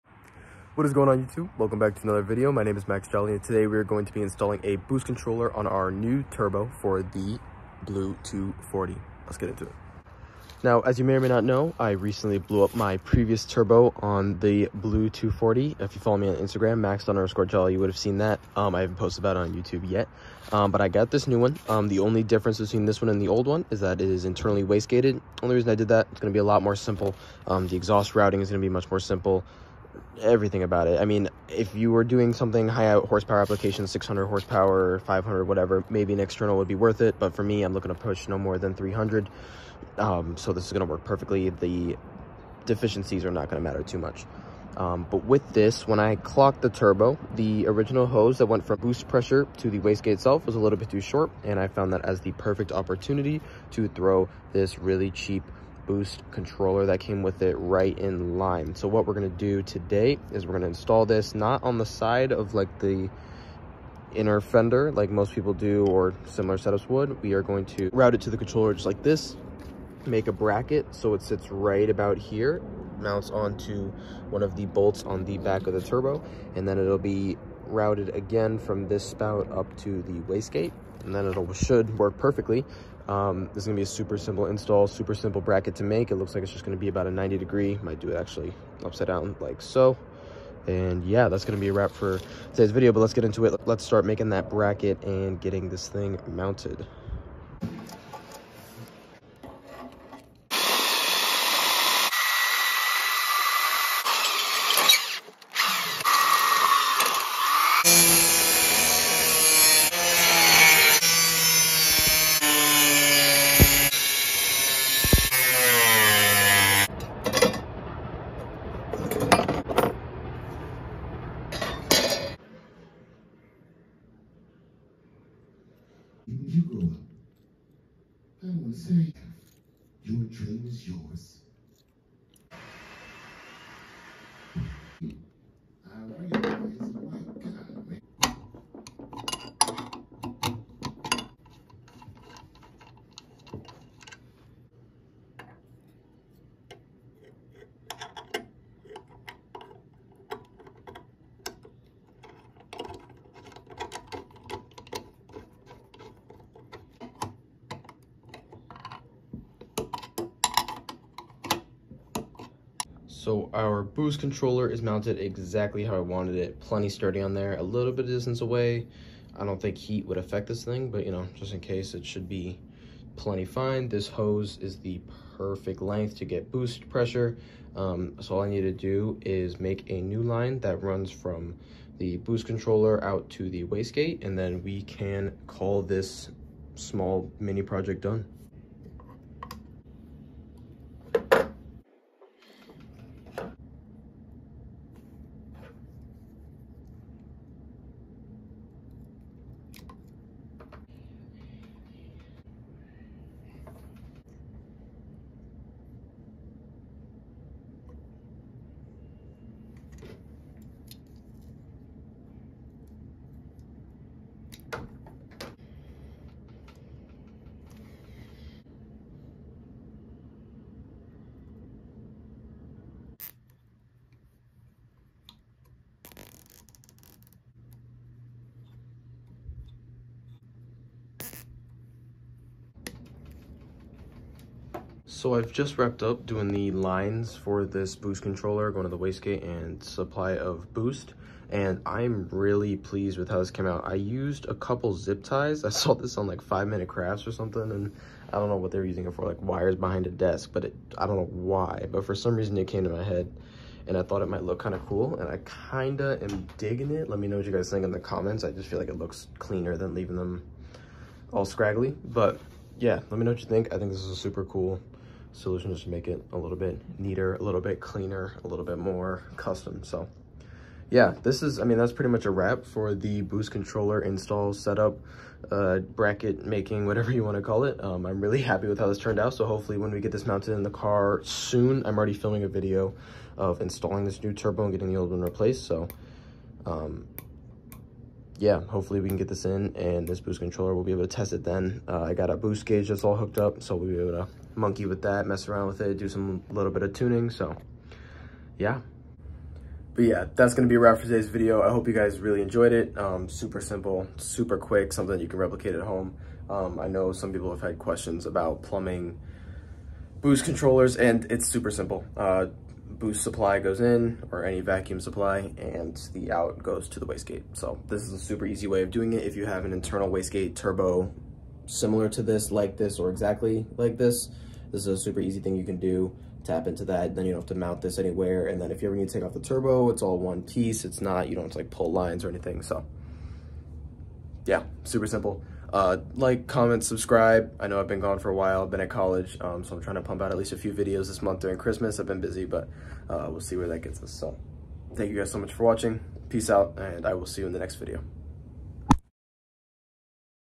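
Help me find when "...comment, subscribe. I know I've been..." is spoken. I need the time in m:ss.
5:36.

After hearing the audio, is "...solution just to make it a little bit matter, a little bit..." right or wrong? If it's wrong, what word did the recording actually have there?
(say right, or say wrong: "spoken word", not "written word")
wrong: "neater", not "matter".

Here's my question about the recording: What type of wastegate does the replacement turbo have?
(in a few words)
Internally wastegated.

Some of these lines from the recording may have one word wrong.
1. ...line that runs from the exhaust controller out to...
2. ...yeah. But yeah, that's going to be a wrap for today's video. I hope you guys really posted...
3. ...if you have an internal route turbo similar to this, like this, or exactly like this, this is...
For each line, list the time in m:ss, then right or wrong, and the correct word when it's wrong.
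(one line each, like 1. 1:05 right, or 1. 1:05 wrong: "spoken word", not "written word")
1. 3:00 wrong: "boost", not "exhaust"
2. 4:58 wrong: "enjoyed", not "posted"
3. 5:19 wrong: "wastegate", not "route".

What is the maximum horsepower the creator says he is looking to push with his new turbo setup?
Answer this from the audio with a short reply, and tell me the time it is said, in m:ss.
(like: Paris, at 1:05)
300, at 0:38.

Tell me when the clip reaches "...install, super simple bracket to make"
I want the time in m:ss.
1:24.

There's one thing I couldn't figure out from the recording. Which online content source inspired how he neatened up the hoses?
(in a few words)
Five minute crafts.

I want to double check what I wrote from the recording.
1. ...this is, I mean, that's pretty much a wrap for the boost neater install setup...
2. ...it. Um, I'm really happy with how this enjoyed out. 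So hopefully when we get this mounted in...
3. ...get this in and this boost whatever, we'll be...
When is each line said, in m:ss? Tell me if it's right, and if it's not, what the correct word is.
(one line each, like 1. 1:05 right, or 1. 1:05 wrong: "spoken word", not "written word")
1. 4:31 wrong: "controller", not "neater"
2. 4:37 wrong: "turned", not "enjoyed"
3. 4:49 wrong: "controller", not "whatever".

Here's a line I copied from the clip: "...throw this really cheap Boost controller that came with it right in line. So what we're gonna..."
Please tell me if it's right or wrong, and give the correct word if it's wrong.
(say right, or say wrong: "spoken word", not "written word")
right.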